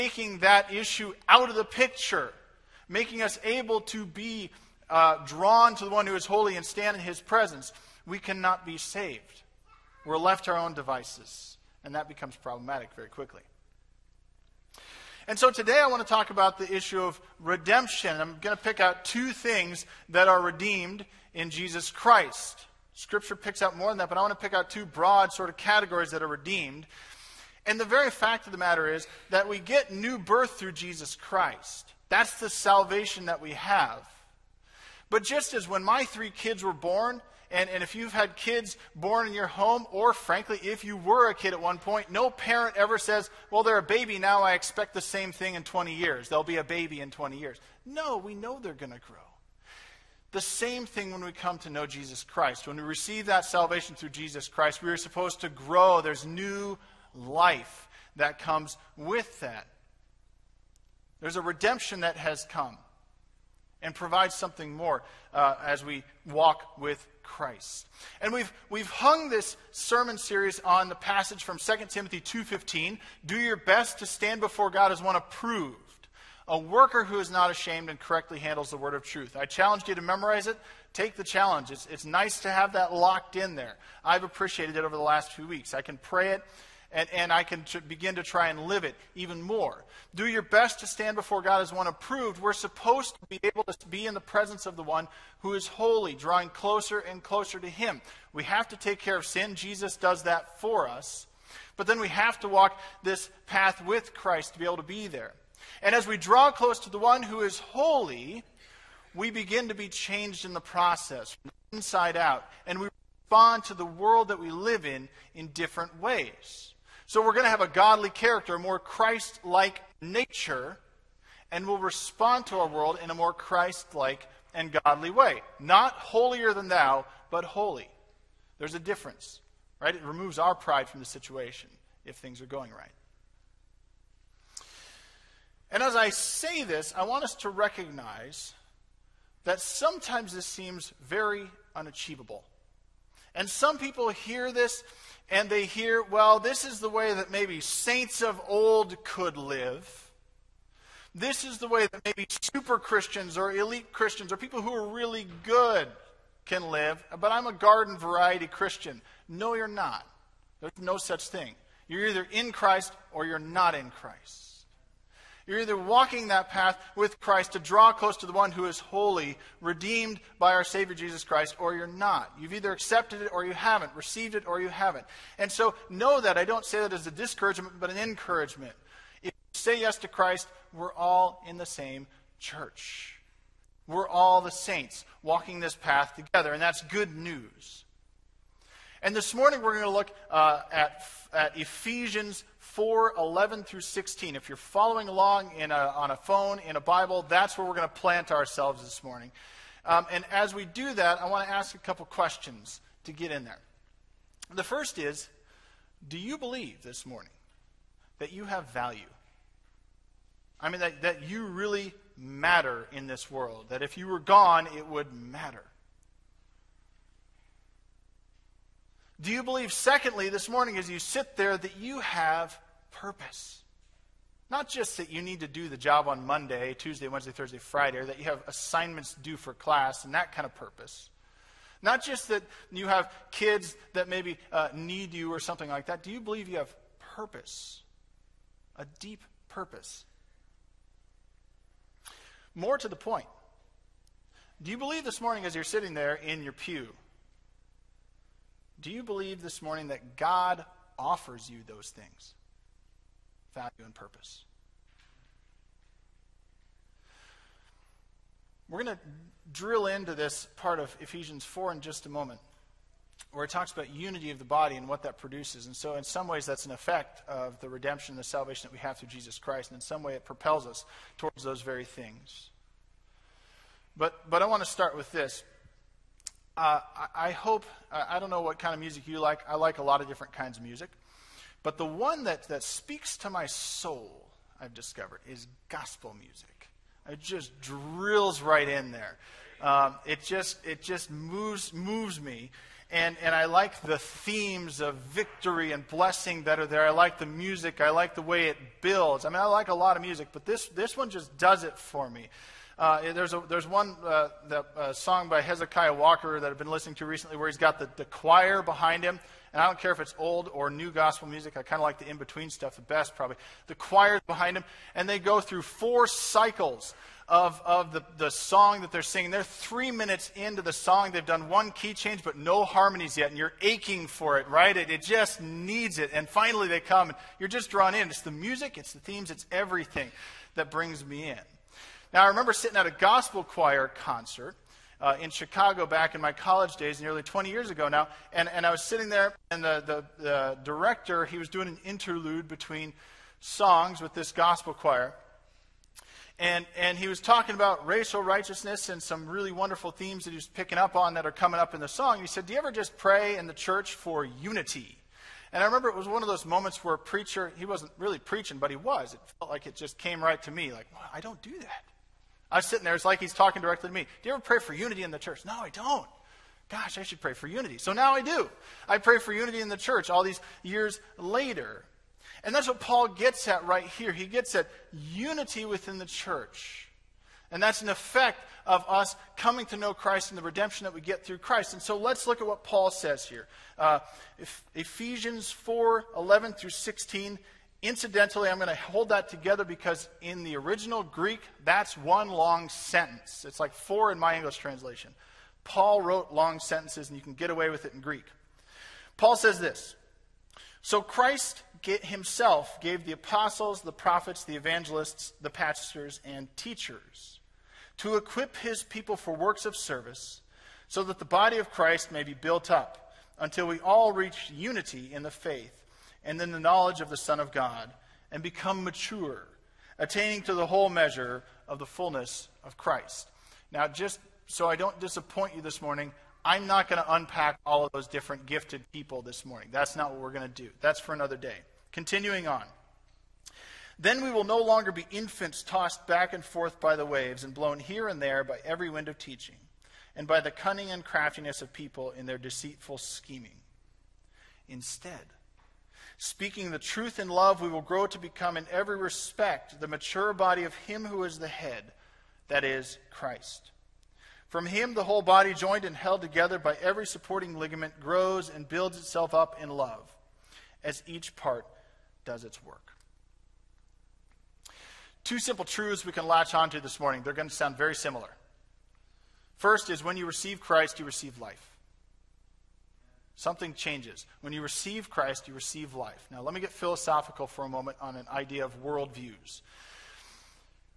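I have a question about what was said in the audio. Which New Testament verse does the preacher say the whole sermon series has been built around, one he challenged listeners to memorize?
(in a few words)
2 Timothy 2:15.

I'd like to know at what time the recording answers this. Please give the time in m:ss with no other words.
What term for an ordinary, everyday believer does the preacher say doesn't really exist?
2:37.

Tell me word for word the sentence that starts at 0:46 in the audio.
They'll be a baby in 20 years.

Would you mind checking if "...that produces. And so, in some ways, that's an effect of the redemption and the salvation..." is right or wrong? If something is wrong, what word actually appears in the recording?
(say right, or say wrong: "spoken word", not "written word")
right.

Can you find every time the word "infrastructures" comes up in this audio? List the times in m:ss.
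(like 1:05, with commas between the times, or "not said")
not said.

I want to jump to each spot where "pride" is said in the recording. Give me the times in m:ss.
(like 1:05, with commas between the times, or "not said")
2:10.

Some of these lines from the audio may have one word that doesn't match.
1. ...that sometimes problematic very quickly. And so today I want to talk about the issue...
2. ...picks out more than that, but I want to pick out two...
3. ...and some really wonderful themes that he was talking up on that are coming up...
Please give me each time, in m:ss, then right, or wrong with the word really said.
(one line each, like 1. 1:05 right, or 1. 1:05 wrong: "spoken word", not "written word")
1. 0:11 wrong: "becomes", not "sometimes"
2. 0:23 right
3. 5:48 wrong: "picking", not "talking".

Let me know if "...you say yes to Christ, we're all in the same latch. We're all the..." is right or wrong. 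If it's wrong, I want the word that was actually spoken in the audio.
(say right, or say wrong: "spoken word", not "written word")
wrong: "church", not "latch".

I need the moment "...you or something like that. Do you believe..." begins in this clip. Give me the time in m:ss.
3:55.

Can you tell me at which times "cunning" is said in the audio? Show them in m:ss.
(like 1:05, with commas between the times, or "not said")
7:20.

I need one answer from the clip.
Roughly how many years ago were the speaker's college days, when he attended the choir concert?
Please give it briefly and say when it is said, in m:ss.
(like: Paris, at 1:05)
20, at 5:36.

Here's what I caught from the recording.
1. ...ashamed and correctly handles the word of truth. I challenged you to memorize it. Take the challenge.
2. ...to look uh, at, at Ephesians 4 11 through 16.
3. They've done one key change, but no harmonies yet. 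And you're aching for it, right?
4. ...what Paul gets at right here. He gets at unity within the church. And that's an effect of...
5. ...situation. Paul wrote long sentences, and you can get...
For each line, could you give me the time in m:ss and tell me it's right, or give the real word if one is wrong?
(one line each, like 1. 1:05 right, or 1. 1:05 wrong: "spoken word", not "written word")
1. 1:17 right
2. 3:09 right
3. 5:21 right
4. 6:12 right
5. 6:34 wrong: "translation", not "situation".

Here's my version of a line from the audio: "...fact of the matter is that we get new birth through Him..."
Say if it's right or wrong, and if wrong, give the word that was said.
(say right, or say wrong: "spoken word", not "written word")
wrong: "Jesus", not "Him".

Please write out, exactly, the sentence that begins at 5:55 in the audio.
And I remember it was one of those moments where a preacher, he wasn't really preaching, but he was.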